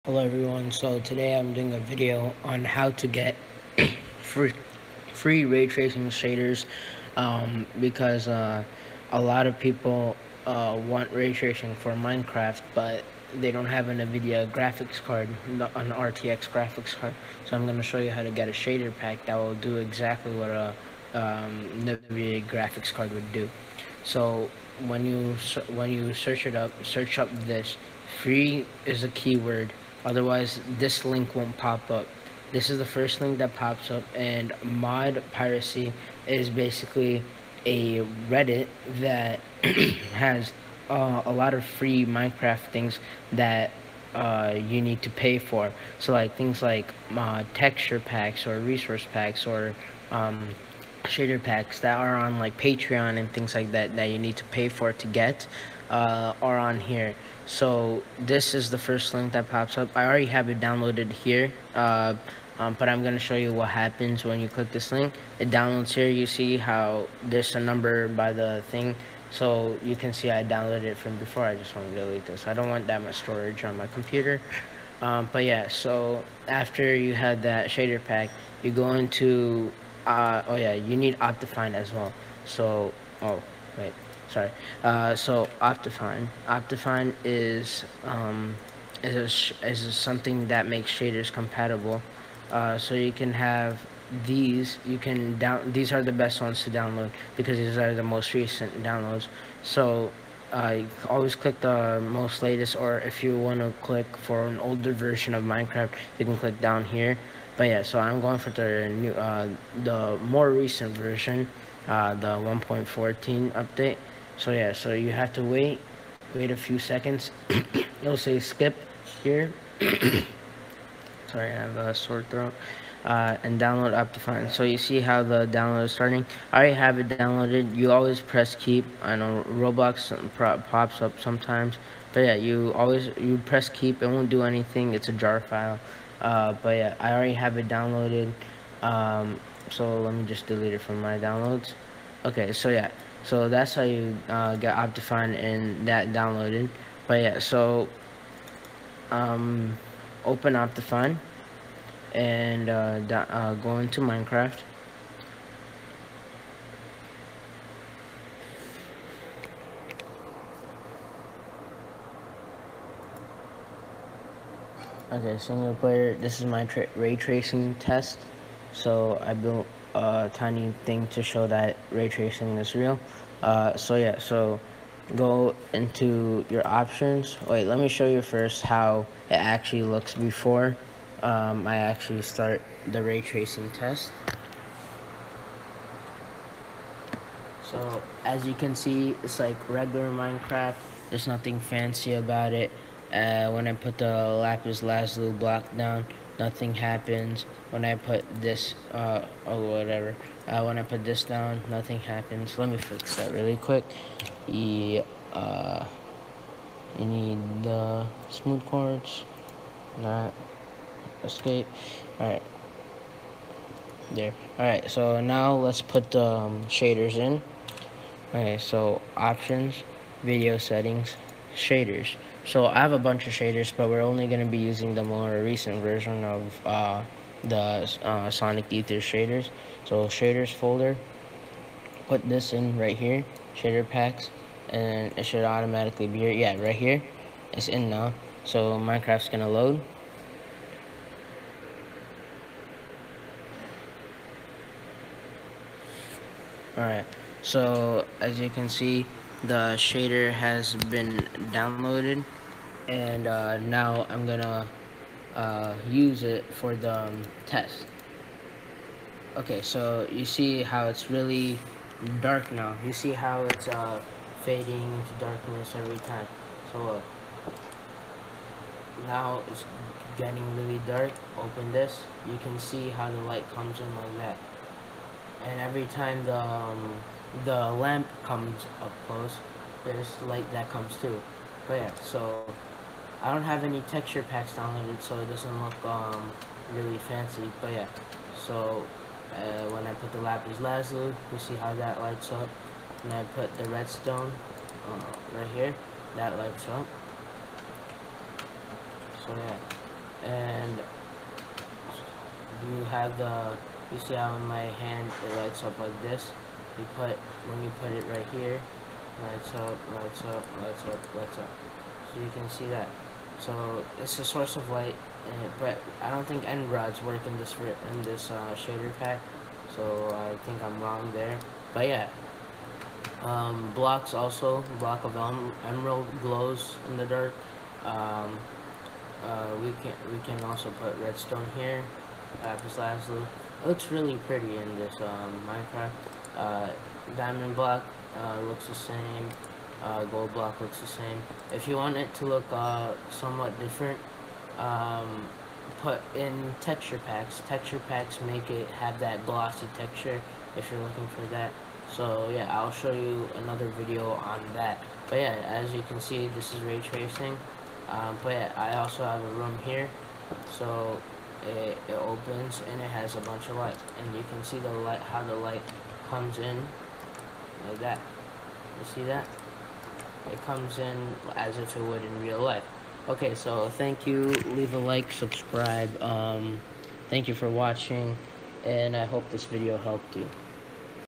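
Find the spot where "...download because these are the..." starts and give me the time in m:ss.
1:36.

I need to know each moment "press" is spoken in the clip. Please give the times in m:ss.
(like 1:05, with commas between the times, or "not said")
2:08, 2:13.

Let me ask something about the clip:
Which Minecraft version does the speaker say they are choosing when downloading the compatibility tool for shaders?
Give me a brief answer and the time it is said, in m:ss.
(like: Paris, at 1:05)
1.14, at 1:52.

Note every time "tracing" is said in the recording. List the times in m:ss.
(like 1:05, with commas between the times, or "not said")
0:05, 0:11, 2:47, 2:52, 3:03, 5:56.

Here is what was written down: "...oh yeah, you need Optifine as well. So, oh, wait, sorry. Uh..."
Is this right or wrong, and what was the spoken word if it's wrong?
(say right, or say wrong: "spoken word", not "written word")
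right.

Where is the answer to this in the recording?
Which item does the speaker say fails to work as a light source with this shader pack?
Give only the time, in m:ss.
5:16.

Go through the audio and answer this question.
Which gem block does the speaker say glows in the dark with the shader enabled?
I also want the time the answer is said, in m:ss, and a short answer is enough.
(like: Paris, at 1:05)
emerald, at 5:25.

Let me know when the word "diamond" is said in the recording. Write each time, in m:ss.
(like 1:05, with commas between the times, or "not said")
5:37.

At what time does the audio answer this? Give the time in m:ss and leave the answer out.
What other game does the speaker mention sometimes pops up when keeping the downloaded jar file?
2:09.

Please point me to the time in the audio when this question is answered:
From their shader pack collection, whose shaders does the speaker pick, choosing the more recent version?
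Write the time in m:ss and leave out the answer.
3:48.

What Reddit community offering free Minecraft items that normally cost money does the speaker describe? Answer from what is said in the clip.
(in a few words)
mod piracy.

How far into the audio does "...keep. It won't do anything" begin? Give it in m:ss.
2:13.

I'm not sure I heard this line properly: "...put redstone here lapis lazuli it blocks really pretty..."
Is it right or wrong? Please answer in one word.
wrong.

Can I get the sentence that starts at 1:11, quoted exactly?
I just want to delete this.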